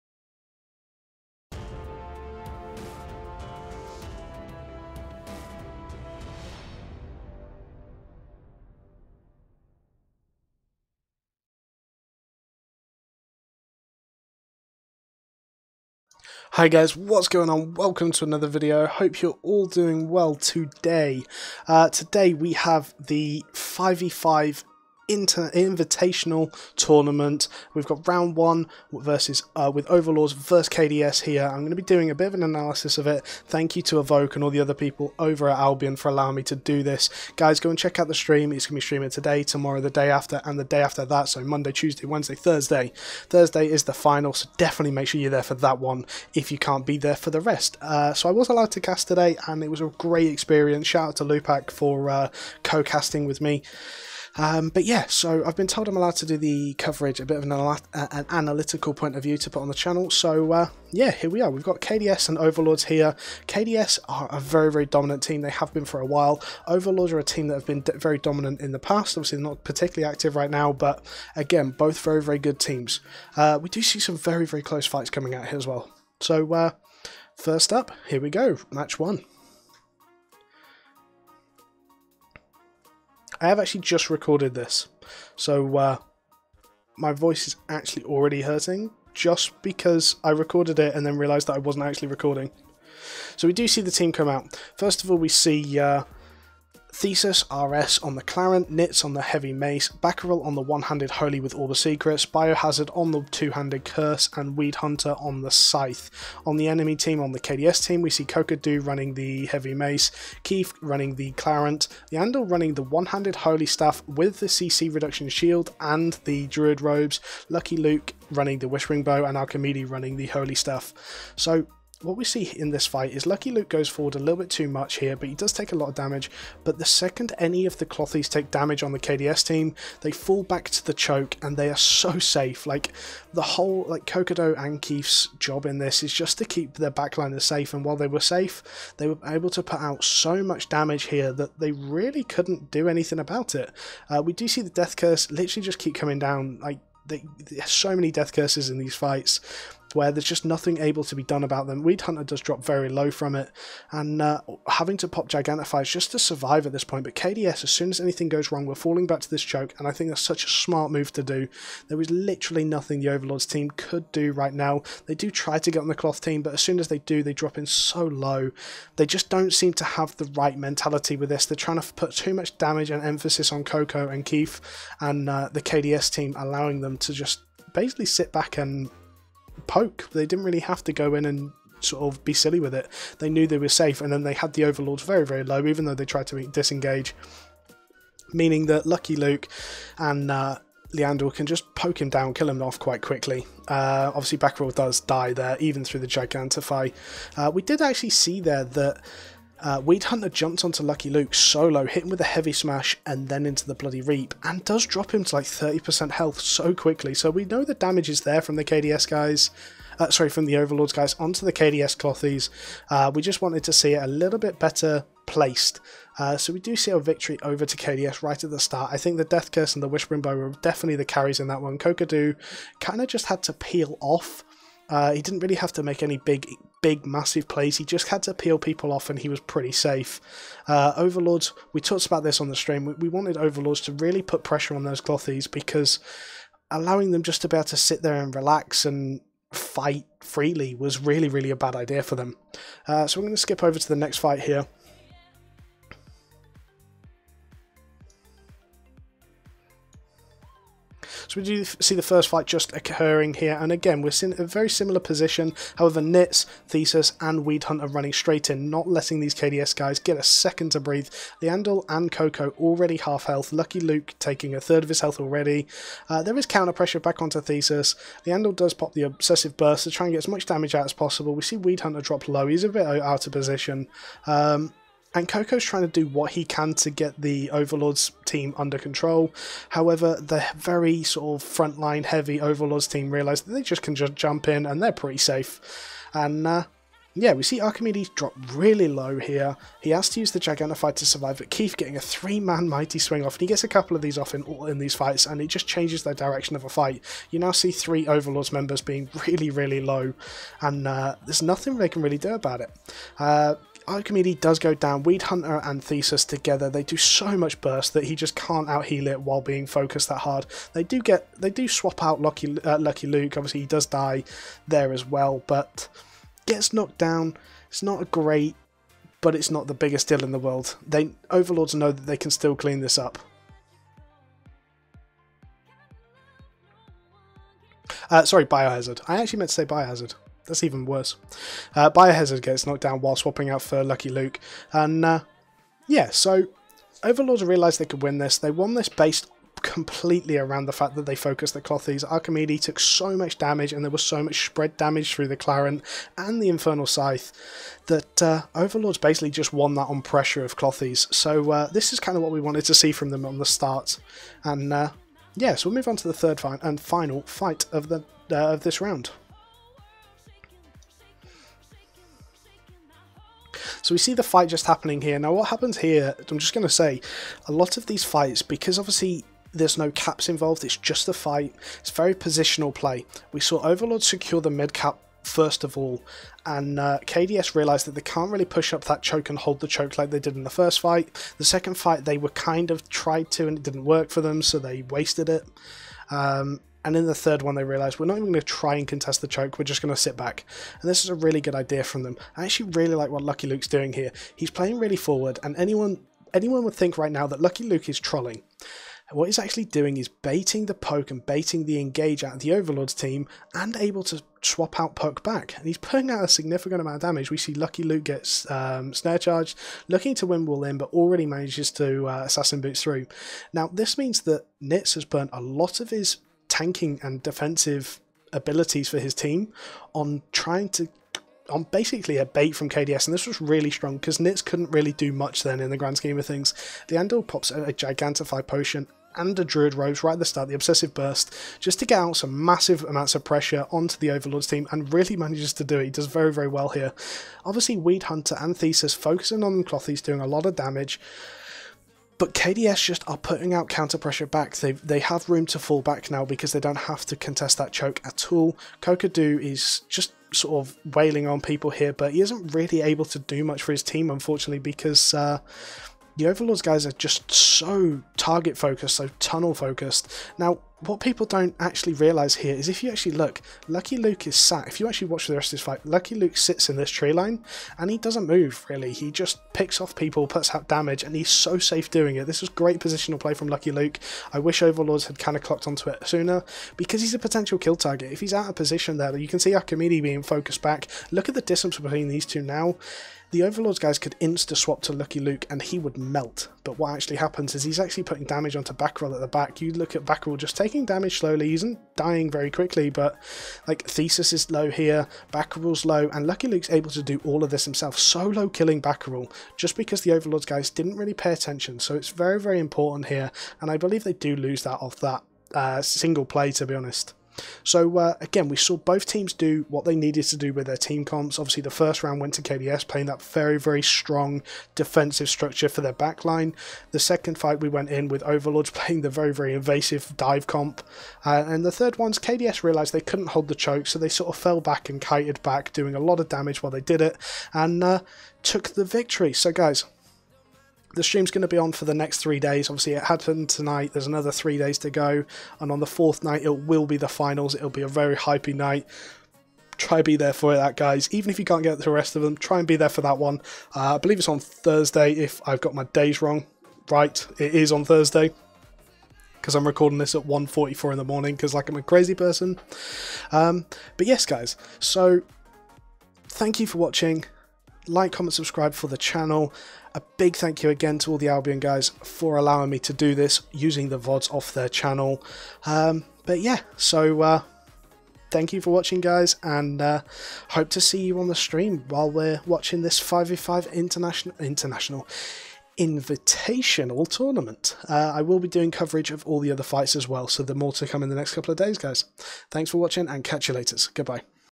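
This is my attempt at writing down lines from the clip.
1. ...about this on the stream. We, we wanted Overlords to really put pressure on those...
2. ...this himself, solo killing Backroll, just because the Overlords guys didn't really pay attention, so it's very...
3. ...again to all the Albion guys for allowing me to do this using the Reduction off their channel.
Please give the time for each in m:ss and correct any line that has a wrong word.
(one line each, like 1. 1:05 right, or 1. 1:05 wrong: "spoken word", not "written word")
1. 3:52 right
2. 8:17 right
3. 9:20 wrong: "VODs", not "Reduction".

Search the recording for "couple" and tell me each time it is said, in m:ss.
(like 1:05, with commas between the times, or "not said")
4:53, 9:41.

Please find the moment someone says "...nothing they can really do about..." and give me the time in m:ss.
5:01.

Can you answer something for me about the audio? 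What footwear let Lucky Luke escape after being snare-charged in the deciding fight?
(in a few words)
Assassin Boots.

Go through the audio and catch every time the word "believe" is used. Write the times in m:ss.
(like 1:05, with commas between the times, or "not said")
8:23, 9:03.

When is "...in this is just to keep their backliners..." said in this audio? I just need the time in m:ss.
2:15.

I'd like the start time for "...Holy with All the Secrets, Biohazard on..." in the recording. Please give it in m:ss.
1:41.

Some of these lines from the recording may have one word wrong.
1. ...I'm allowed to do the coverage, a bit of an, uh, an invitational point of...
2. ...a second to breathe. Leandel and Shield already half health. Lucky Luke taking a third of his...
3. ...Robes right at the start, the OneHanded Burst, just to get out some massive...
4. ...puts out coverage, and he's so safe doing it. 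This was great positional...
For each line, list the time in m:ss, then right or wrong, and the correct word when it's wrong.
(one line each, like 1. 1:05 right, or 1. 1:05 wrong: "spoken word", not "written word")
1. 0:55 wrong: "analytical", not "invitational"
2. 4:20 wrong: "Coco", not "Shield"
3. 7:09 wrong: "Obsessive", not "OneHanded"
4. 7:50 wrong: "damage", not "coverage".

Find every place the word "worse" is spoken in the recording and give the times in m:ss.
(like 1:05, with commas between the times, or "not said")
5:30.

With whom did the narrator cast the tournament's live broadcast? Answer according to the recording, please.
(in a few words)
Lupac.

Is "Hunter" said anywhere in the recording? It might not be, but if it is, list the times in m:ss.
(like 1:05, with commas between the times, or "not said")
1:44, 2:32, 3:20, 4:17, 4:31, 5:05, 7:18.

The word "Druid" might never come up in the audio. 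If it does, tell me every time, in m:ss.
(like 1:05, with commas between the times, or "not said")
1:56, 7:09.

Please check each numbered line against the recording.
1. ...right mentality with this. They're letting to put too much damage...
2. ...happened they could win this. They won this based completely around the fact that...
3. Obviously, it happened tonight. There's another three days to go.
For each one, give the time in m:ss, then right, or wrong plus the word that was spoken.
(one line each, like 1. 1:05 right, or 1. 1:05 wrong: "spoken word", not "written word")
1. 2:50 wrong: "trying", not "letting"
2. 5:37 wrong: "realised", not "happened"
3. 8:52 right.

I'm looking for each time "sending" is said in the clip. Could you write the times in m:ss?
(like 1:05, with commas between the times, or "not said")
not said.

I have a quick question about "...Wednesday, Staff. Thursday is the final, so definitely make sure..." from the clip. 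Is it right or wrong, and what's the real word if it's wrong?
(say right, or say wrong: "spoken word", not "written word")
wrong: "Thursday", not "Staff".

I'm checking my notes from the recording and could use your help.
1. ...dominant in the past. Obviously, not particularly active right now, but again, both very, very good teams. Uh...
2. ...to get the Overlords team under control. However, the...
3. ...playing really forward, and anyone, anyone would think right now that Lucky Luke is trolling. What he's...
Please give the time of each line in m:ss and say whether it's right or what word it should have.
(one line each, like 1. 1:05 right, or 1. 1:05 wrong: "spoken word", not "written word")
1. 1:08 right
2. 4:36 right
3. 6:34 right.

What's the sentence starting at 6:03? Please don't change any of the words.
So we see the fight just happening here.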